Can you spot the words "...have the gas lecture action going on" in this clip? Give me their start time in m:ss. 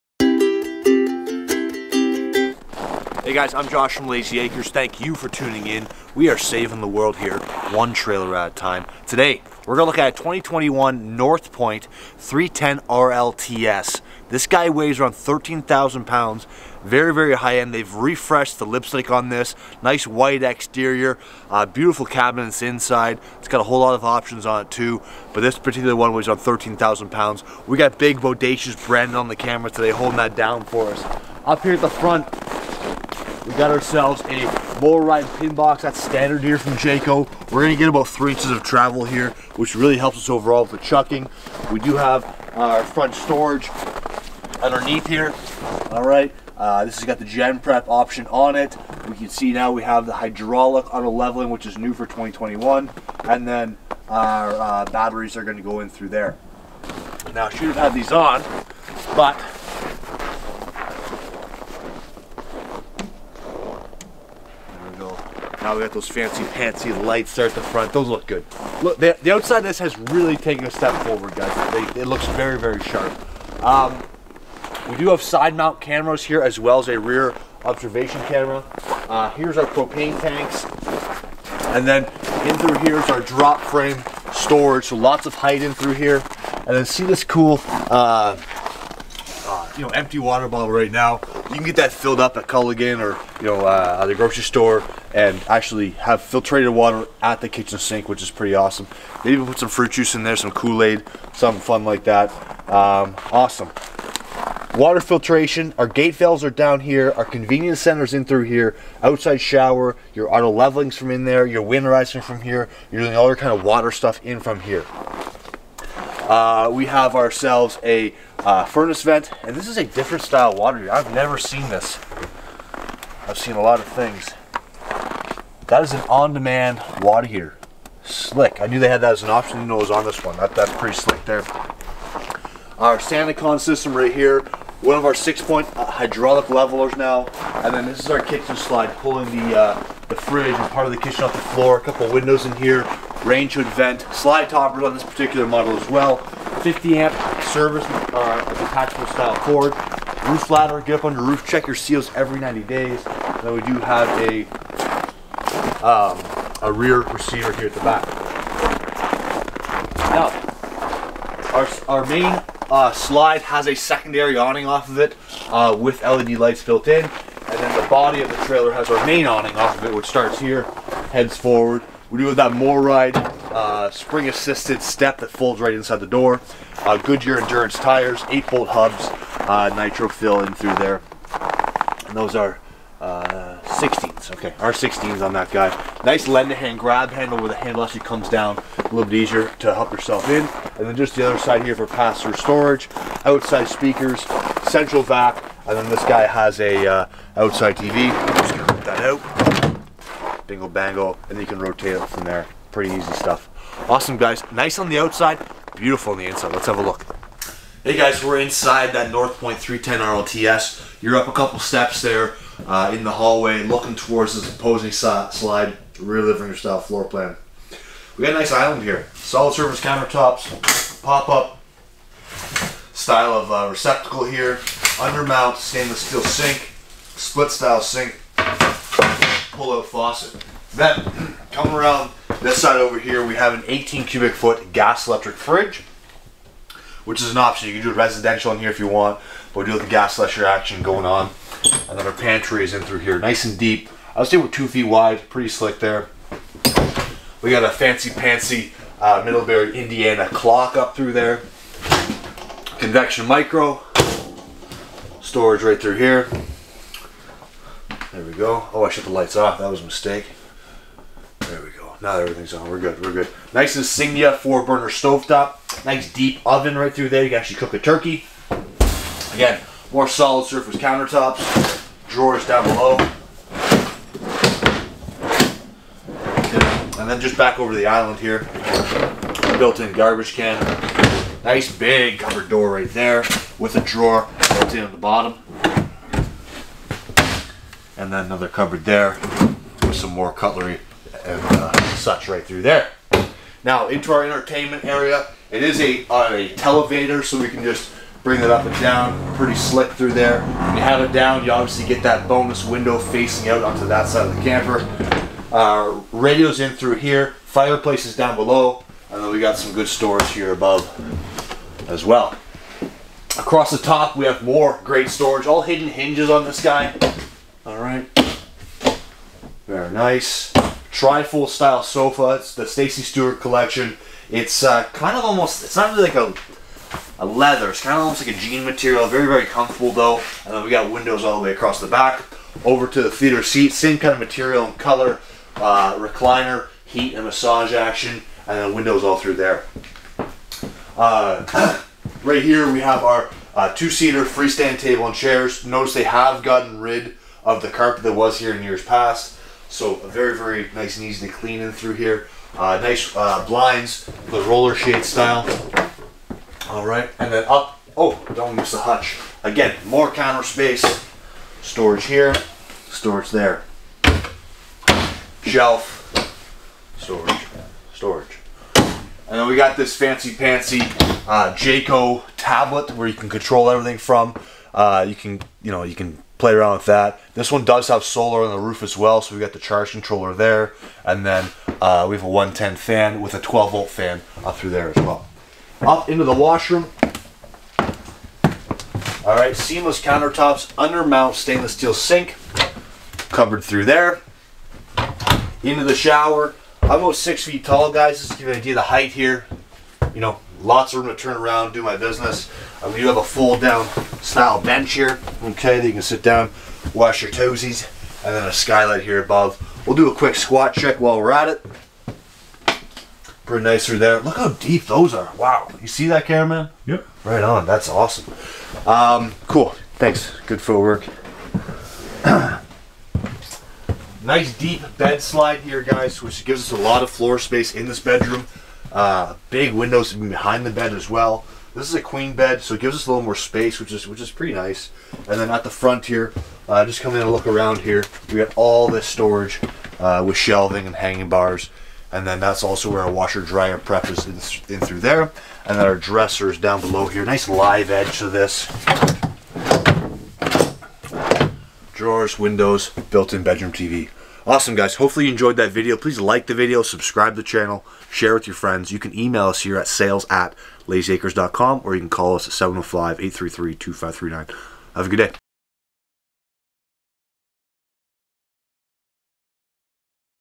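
3:59.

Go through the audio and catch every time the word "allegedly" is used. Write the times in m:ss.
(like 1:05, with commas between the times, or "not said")
not said.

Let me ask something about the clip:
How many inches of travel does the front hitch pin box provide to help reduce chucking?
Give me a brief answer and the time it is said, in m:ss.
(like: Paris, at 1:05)
3, at 0:38.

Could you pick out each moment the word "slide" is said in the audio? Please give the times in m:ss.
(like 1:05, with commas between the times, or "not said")
2:18, 2:24, 2:42, 3:35, 7:05.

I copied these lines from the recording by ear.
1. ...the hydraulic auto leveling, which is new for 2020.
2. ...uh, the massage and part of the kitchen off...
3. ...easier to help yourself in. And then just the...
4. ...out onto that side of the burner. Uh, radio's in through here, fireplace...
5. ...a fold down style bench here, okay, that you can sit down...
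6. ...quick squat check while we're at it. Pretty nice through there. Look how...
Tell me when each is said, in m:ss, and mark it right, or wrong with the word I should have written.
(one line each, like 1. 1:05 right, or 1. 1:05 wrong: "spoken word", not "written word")
1. 0:50 wrong: "2021", not "2020"
2. 2:19 wrong: "fridge", not "massage"
3. 3:09 right
4. 5:03 wrong: "camper", not "burner"
5. 6:43 right
6. 6:50 right.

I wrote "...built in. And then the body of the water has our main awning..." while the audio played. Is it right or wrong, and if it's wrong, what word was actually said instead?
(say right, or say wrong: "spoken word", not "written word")
wrong: "trailer", not "water".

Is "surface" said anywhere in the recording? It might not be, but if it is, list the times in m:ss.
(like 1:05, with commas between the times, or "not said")
3:39, 4:30.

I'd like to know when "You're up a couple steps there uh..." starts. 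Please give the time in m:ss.
3:31.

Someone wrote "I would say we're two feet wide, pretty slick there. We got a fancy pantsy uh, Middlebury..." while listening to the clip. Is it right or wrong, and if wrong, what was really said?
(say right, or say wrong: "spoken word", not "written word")
right.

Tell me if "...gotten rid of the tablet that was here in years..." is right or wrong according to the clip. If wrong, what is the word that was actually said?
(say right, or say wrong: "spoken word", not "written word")
wrong: "carpet", not "tablet".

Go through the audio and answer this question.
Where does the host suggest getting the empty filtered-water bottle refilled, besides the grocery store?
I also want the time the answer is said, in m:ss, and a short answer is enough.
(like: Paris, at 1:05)
Culligan, at 1:32.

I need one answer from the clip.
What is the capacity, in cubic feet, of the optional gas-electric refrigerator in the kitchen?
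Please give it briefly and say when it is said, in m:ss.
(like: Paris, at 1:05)
18, at 3:53.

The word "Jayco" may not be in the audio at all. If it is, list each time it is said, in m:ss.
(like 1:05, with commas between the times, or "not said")
0:36, 6:11.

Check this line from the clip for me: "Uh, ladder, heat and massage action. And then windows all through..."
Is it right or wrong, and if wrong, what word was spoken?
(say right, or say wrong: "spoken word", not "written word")
wrong: "recliner", not "ladder".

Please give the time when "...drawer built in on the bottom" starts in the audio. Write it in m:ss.
4:43.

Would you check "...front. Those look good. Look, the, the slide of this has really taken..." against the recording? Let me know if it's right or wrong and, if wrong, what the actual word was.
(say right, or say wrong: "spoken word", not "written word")
wrong: "outside", not "slide".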